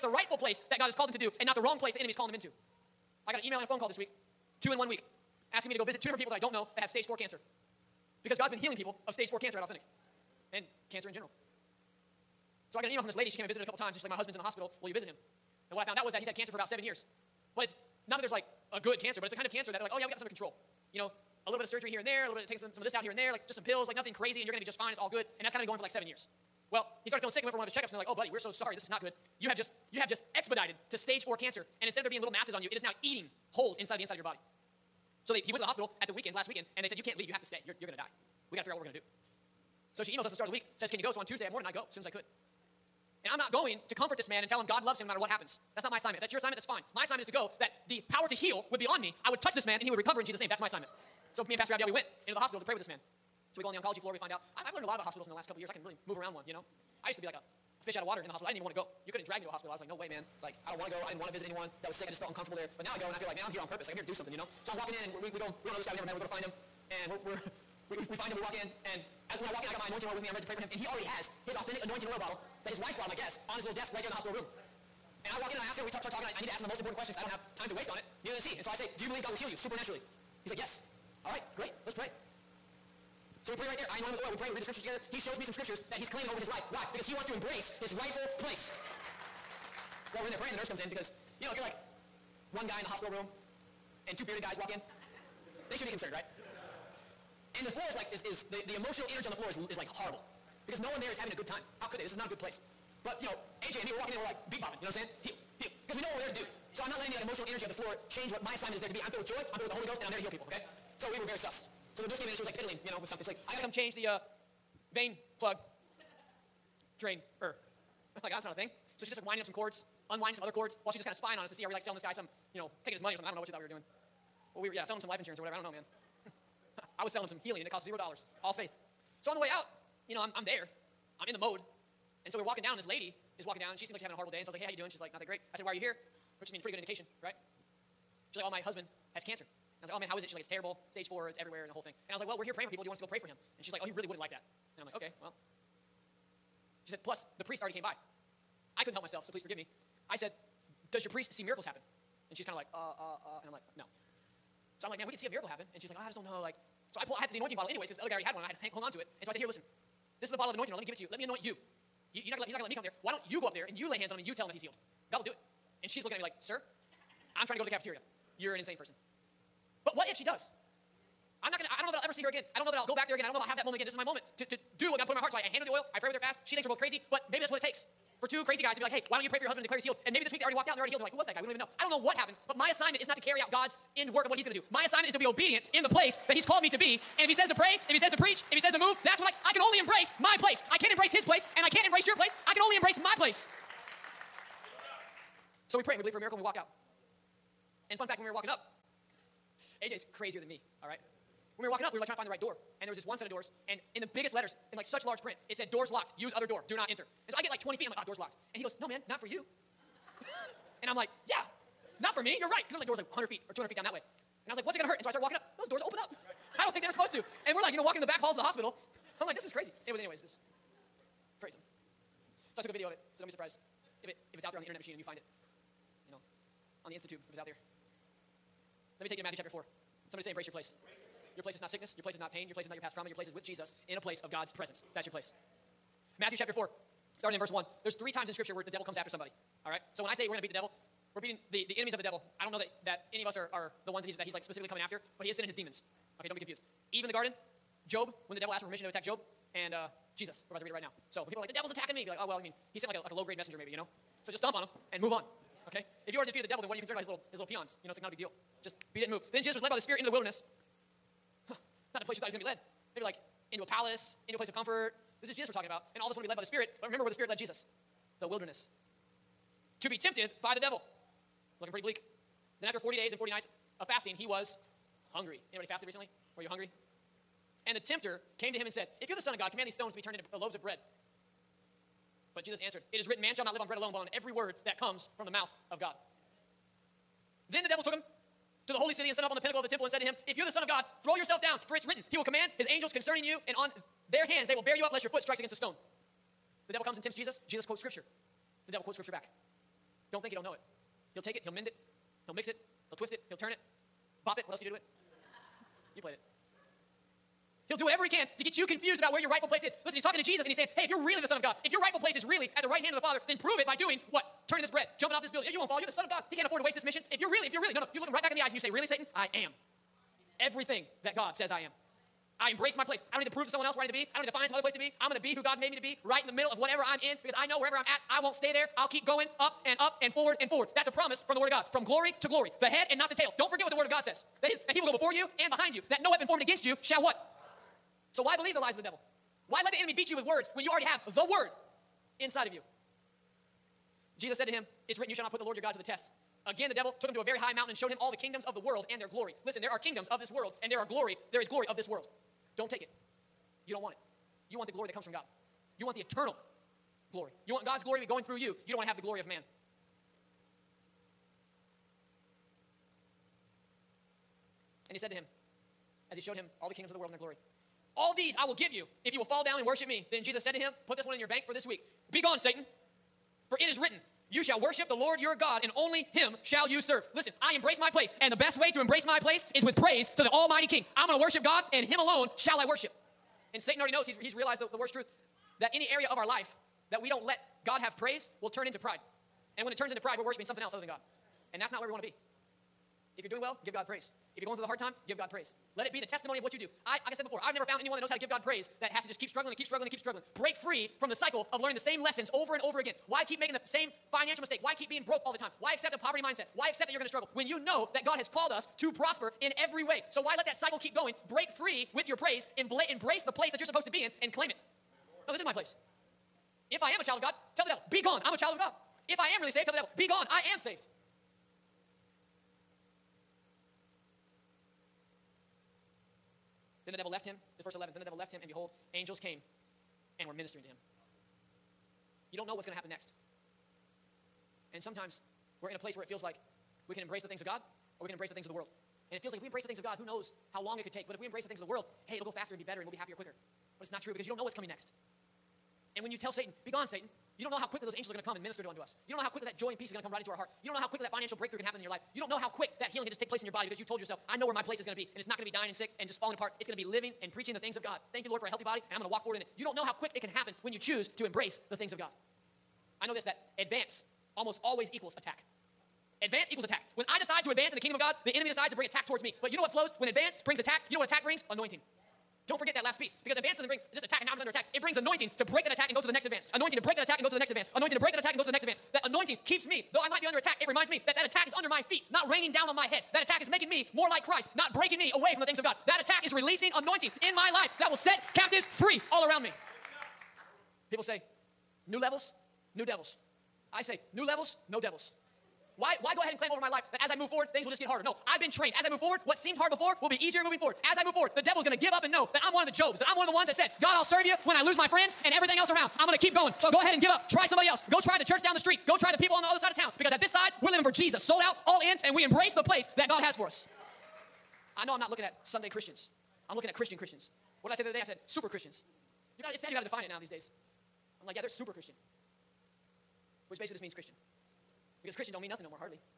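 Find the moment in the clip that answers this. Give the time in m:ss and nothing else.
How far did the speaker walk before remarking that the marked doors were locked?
3:27.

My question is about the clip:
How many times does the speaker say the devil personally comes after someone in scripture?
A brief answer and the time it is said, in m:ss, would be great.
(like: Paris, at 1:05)
3, at 3:57.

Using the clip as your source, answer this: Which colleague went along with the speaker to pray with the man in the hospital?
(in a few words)
Pastor Abdiel.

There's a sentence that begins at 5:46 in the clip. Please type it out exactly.
Again, the devil took him to a very high mountain and showed him all the kingdoms of the world and their glory.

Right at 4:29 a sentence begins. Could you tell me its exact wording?
To be tempted by the devil.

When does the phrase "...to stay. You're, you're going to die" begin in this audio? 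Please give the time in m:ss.
0:37.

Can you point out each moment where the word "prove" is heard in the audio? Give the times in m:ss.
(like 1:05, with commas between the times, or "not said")
5:13, 5:23.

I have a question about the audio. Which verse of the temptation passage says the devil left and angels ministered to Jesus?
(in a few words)
Verse 11.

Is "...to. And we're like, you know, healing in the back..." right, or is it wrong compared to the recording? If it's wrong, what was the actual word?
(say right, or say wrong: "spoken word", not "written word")
wrong: "walking", not "healing".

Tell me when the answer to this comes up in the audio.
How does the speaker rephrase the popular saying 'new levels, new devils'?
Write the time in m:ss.
8:14.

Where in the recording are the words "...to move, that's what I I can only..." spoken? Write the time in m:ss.
3:08.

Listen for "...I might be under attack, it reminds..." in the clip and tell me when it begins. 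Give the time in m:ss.
8:00.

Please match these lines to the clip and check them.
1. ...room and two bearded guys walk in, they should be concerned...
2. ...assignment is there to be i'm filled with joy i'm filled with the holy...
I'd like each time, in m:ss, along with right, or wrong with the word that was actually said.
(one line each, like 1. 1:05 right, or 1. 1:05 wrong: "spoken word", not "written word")
1. 1:33 right
2. 1:48 right.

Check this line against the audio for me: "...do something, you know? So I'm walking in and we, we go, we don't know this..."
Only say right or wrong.
right.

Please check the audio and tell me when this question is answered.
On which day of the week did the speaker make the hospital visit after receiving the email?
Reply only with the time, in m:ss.
0:41.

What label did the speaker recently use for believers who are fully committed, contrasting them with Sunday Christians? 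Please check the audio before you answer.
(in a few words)
Super Christians.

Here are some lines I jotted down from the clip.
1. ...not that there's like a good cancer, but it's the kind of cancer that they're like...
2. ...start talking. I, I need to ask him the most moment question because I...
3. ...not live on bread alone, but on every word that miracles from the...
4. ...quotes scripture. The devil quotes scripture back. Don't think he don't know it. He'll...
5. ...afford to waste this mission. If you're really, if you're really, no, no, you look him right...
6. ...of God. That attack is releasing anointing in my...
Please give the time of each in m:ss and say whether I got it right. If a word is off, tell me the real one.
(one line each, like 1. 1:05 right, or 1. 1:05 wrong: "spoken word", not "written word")
1. 0:18 right
2. 1:16 wrong: "important", not "moment"
3. 4:43 wrong: "comes", not "miracles"
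4. 4:57 right
5. 5:16 right
6. 8:05 right.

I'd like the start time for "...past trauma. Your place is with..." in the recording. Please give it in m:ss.
3:52.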